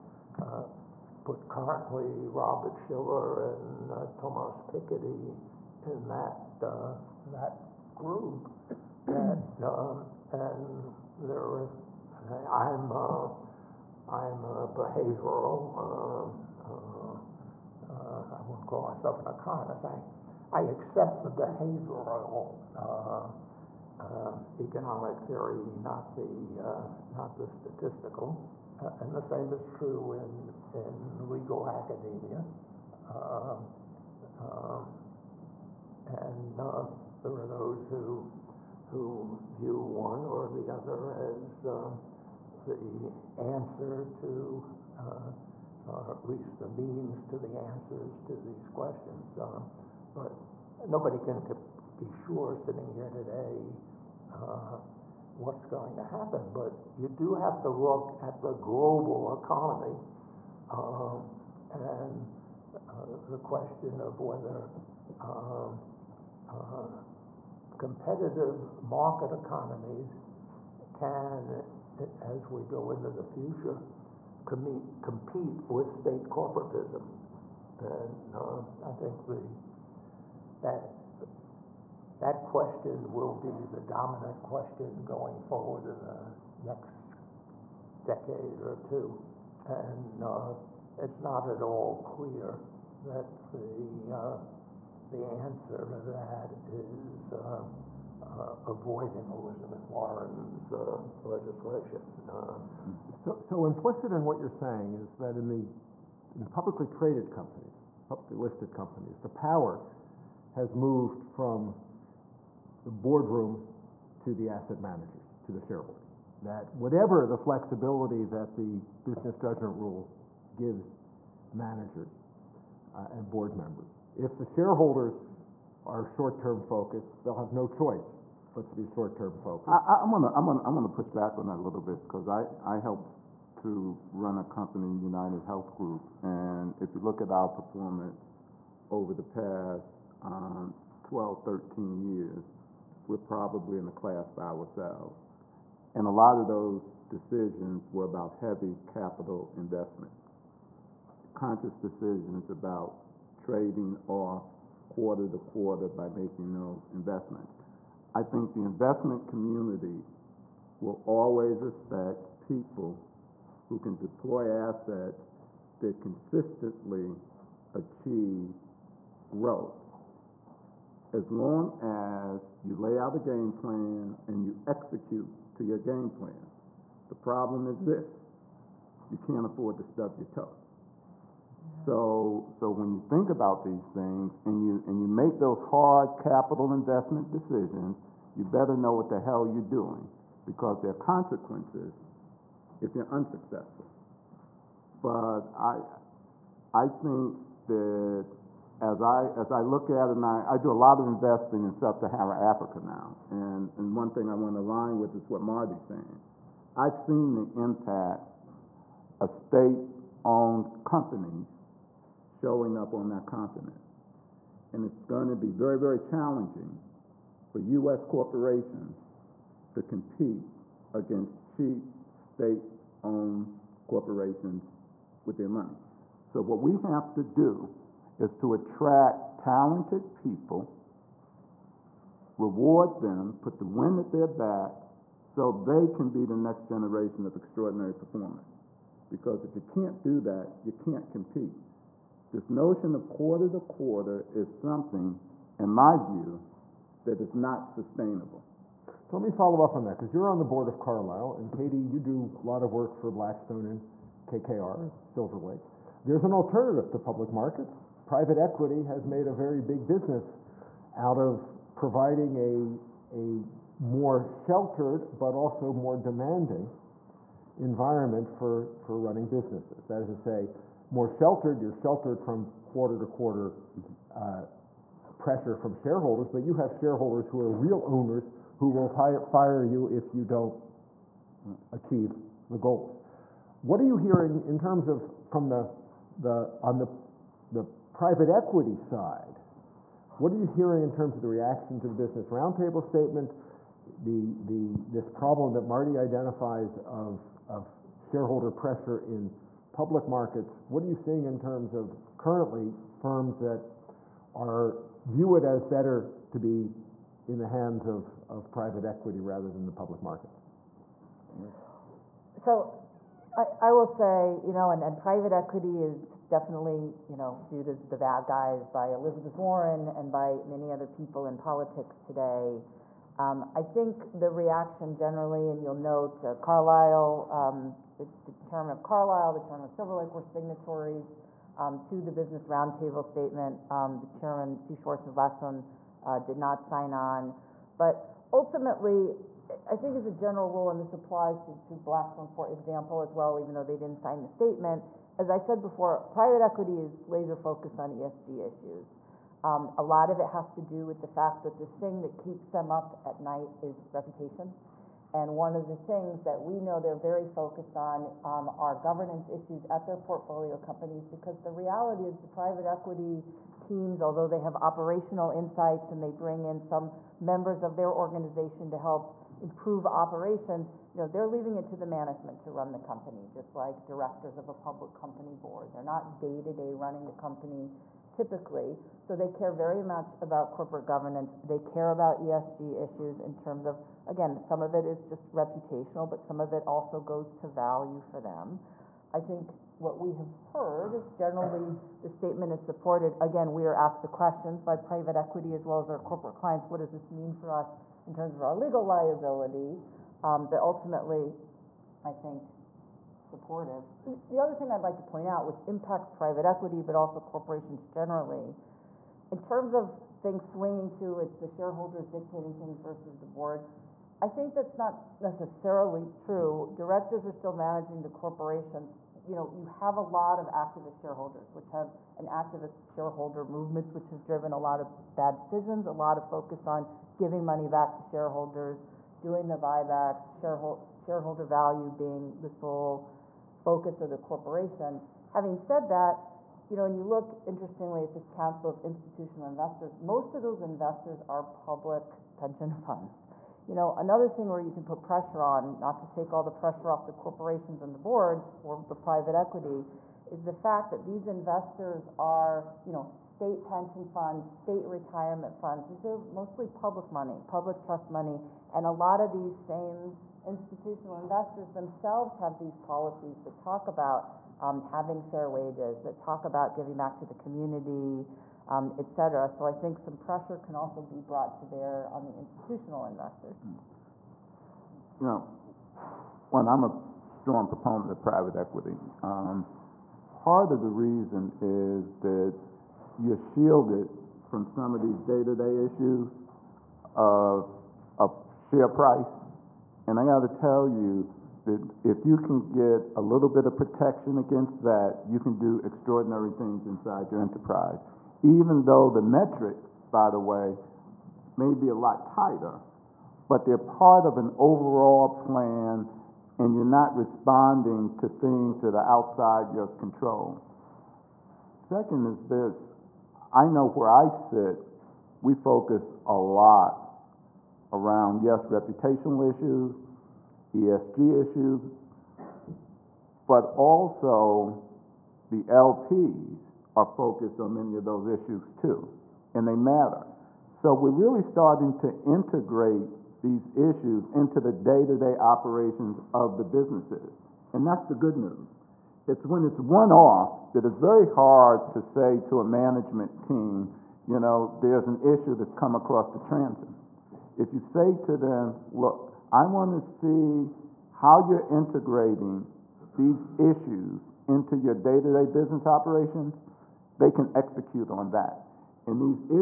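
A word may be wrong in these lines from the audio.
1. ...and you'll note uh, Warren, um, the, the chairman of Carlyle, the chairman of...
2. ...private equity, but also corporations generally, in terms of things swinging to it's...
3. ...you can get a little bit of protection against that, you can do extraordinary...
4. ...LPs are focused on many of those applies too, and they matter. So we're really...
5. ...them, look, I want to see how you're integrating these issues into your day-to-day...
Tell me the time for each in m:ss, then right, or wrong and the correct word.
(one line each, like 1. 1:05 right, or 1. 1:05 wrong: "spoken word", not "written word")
1. 5:25 wrong: "Carlyle", not "Warren"
2. 6:46 right
3. 8:12 right
4. 8:45 wrong: "issues", not "applies"
5. 9:08 right.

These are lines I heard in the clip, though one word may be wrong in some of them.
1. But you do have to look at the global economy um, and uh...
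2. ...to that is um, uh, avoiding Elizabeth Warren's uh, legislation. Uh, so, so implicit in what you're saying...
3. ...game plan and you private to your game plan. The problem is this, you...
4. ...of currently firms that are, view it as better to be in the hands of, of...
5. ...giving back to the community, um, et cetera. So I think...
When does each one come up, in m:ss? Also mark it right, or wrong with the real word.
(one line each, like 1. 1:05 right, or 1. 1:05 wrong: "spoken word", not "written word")
1. 0:56 right
2. 1:35 right
3. 2:53 wrong: "execute", not "private"
4. 5:01 right
5. 7:46 right.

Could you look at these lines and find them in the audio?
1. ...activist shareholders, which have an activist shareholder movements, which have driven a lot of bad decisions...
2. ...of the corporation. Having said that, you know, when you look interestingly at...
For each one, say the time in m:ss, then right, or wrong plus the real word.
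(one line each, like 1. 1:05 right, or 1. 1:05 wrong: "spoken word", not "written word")
1. 7:00 right
2. 7:14 right.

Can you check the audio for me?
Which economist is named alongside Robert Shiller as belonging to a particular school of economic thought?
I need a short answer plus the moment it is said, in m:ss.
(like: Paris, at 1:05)
Thomas Piketty, at 0:04.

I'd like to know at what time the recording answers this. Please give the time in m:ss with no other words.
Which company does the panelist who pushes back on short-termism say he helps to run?
2:14.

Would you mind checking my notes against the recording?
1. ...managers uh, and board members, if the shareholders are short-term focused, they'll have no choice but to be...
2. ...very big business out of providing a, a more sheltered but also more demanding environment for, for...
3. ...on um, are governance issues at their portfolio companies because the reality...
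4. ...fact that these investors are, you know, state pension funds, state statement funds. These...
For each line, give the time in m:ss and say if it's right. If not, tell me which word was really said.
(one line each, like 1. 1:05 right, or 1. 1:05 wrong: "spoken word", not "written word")
1. 2:01 right
2. 4:19 right
3. 5:57 right
4. 7:30 wrong: "retirement", not "statement".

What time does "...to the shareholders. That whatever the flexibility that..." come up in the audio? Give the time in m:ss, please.
1:55.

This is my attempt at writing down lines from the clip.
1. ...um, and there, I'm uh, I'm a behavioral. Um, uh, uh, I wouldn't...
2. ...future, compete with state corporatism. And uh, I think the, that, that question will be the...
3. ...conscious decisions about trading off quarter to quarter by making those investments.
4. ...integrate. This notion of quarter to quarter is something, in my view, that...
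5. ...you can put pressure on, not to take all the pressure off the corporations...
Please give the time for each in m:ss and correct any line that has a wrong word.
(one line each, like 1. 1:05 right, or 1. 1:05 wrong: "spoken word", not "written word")
1. 0:09 right
2. 1:13 right
3. 2:31 right
4. 4:01 wrong: "compete", not "integrate"
5. 7:24 right.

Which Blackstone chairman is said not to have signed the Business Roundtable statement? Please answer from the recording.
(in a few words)
Steve Schwarzman.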